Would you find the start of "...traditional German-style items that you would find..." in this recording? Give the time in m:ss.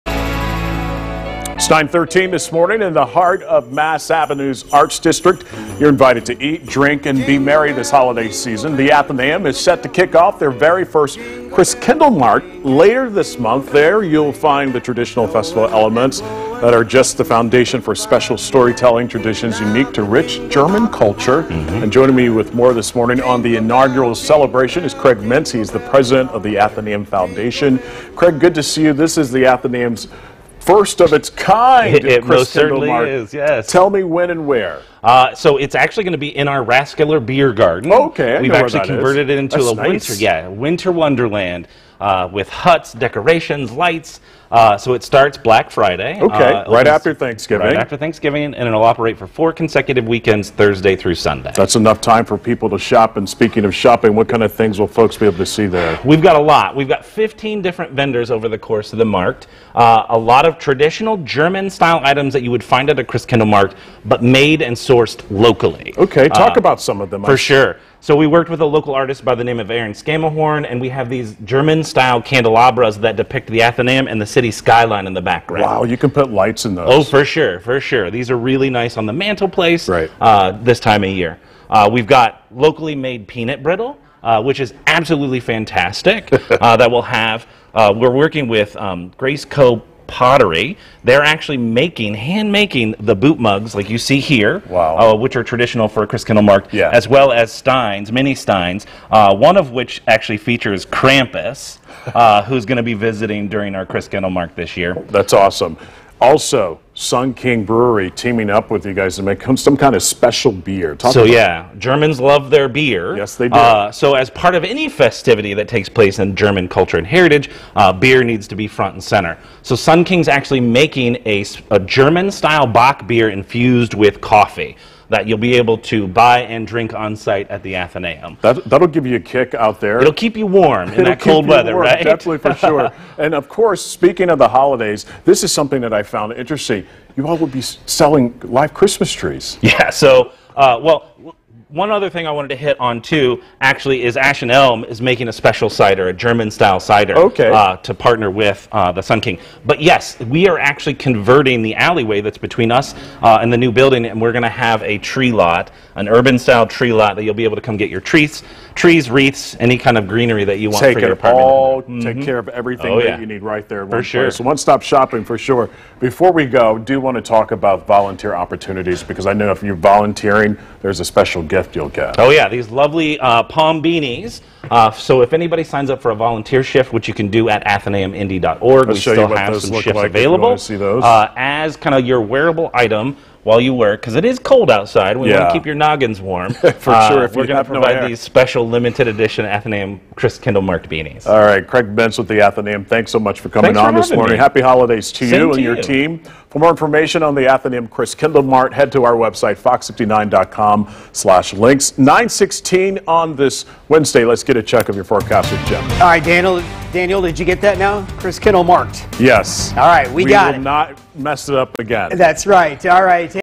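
1:00.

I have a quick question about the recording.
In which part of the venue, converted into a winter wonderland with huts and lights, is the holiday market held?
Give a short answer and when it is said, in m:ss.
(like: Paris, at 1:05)
Rathskeller Beer Garden, at 0:36.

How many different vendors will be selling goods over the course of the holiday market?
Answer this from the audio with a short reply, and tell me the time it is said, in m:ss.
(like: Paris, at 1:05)
15, at 0:57.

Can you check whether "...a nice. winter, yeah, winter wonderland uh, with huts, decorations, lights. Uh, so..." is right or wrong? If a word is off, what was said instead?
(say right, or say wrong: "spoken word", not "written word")
right.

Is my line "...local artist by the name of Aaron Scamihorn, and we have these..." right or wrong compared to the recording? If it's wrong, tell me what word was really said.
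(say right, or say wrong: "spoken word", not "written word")
right.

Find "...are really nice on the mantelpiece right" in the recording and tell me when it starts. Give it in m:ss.
1:18.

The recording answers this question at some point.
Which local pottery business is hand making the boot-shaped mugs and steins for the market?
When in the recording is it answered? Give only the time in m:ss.
1:29.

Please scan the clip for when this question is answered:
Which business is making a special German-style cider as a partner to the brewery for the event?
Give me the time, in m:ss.
2:24.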